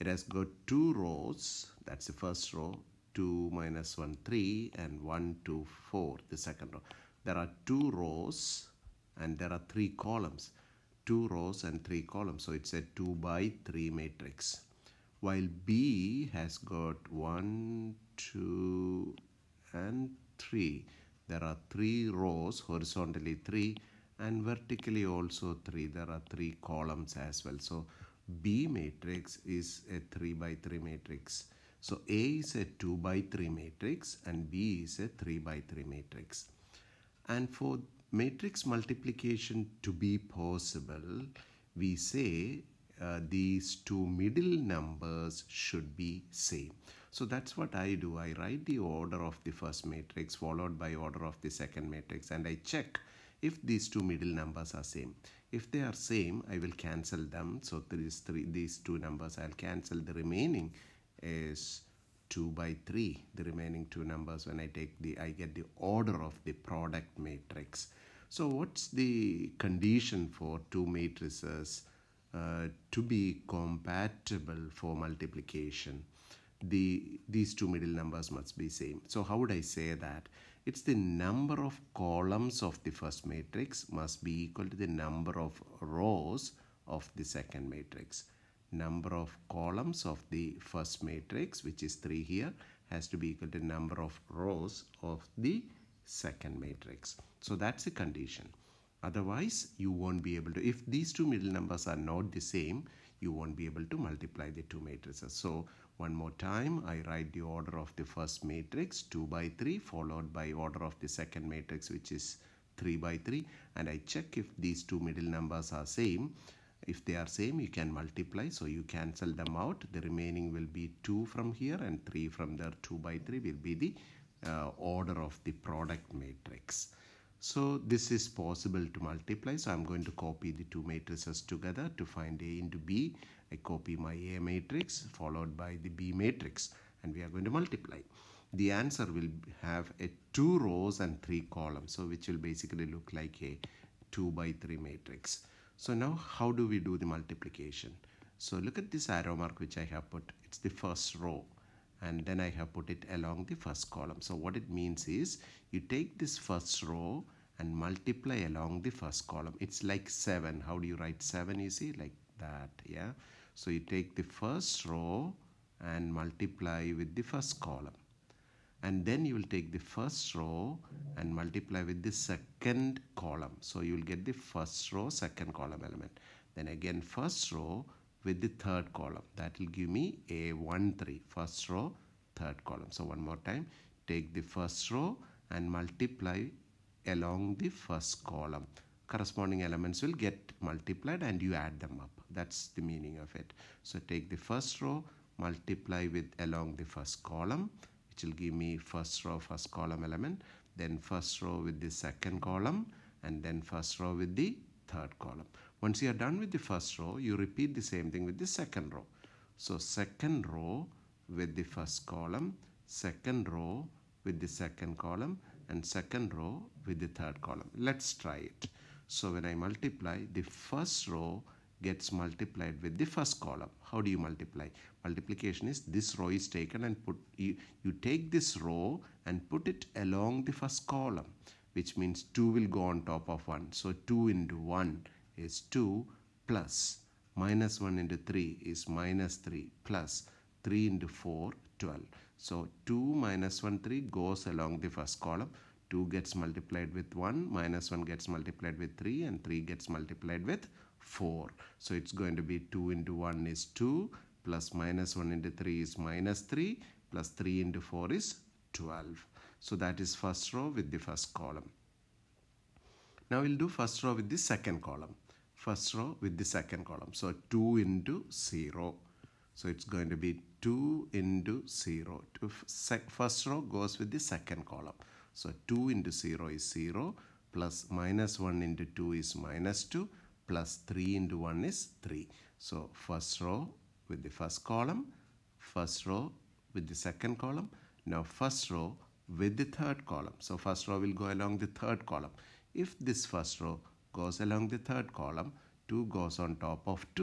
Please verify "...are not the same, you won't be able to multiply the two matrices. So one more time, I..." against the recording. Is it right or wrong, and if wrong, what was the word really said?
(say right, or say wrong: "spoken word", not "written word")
right.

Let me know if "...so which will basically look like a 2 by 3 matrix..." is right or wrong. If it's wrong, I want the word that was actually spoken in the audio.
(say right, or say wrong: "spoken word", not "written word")
right.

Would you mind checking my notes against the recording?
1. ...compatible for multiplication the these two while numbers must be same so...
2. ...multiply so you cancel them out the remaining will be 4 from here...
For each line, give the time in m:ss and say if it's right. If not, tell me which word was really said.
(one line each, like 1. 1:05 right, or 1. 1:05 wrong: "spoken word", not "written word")
1. 1:13 wrong: "middle", not "while"
2. 1:57 wrong: "2", not "4".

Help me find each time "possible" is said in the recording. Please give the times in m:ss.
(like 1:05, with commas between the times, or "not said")
0:40, 2:08.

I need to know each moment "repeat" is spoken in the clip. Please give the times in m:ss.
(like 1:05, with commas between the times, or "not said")
3:27.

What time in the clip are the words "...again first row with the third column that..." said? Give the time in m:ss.
2:56.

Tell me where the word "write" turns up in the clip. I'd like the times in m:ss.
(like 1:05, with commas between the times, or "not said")
0:48, 1:47, 2:40.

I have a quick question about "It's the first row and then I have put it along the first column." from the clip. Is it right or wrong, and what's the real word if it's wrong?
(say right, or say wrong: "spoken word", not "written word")
right.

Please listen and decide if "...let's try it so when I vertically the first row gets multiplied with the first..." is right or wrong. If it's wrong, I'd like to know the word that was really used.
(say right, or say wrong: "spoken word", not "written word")
wrong: "multiply", not "vertically".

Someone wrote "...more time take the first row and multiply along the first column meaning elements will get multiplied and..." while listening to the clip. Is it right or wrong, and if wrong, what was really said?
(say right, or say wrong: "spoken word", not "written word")
wrong: "corresponding", not "meaning".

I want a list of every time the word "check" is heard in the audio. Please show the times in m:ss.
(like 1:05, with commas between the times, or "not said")
0:52, 1:54.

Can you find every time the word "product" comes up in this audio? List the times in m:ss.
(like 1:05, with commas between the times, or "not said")
1:06, 2:05.